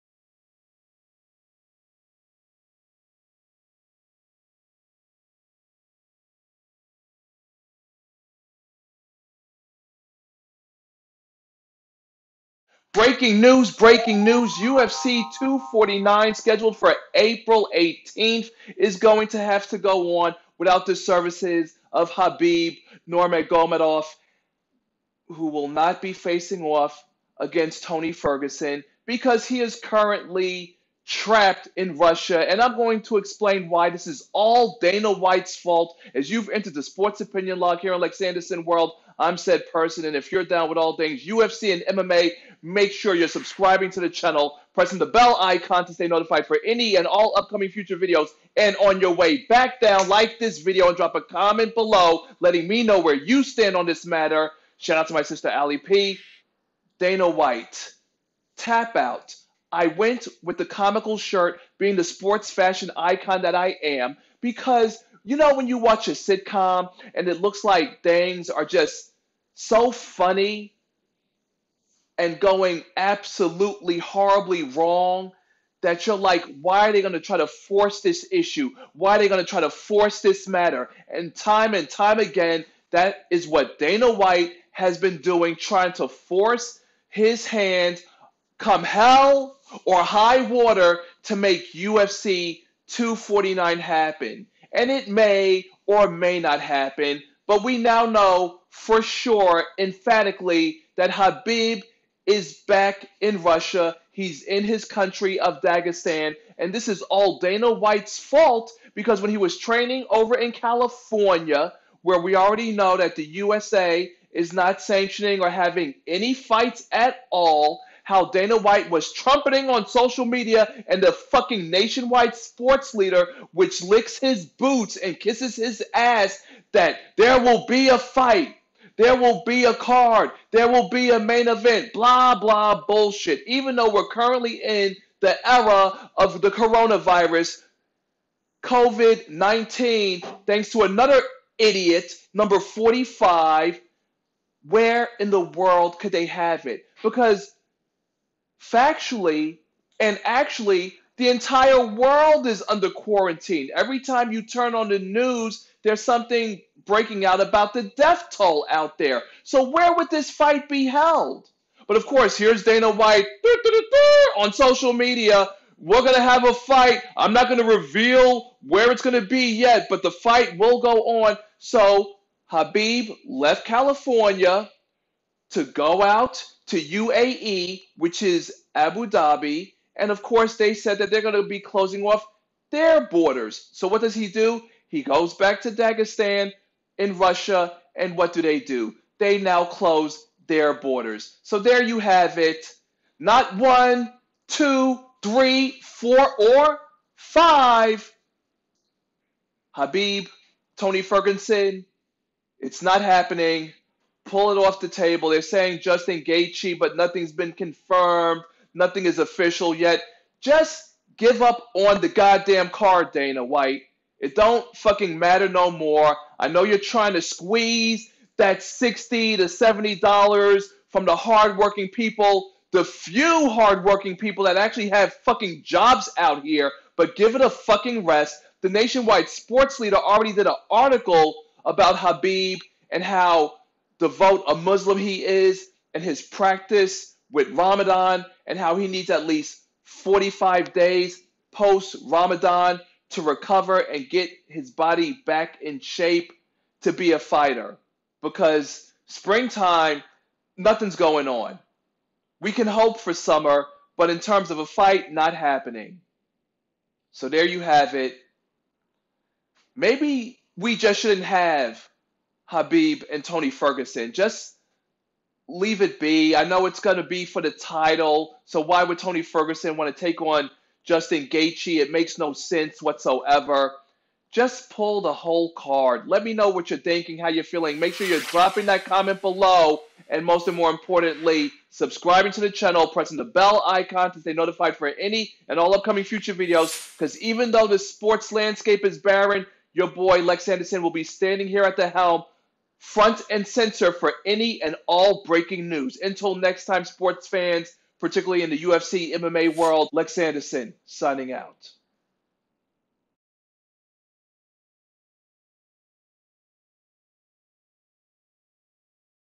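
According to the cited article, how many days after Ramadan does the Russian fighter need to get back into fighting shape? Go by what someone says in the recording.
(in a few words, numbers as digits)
45 days.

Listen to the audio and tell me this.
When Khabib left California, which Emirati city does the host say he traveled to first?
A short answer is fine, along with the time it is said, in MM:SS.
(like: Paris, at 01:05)
Abu Dhabi, at 02:58.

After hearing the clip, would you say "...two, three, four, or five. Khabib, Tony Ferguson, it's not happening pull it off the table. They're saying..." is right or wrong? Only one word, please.
right.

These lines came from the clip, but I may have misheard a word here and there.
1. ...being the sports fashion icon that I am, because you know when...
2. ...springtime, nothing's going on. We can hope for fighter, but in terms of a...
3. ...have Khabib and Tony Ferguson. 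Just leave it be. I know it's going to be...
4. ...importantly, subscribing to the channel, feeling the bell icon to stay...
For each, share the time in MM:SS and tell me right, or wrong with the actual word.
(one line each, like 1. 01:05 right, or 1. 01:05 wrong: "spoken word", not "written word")
1. 01:01 right
2. 04:09 wrong: "summer", not "fighter"
3. 04:21 right
4. 04:40 wrong: "pressing", not "feeling".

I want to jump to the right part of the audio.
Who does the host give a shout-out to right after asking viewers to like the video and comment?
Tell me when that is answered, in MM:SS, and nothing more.
00:55.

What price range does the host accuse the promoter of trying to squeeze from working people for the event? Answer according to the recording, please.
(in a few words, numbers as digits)
$60 to $70.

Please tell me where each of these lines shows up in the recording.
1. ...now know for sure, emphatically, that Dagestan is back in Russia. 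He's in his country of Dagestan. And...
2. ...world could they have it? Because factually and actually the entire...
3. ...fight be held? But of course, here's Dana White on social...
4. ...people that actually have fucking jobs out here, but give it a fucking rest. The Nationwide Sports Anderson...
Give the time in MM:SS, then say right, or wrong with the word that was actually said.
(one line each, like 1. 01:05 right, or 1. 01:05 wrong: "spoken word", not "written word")
1. 01:37 wrong: "Khabib", not "Dagestan"
2. 02:25 right
3. 02:40 right
4. 03:44 wrong: "Leader", not "Anderson".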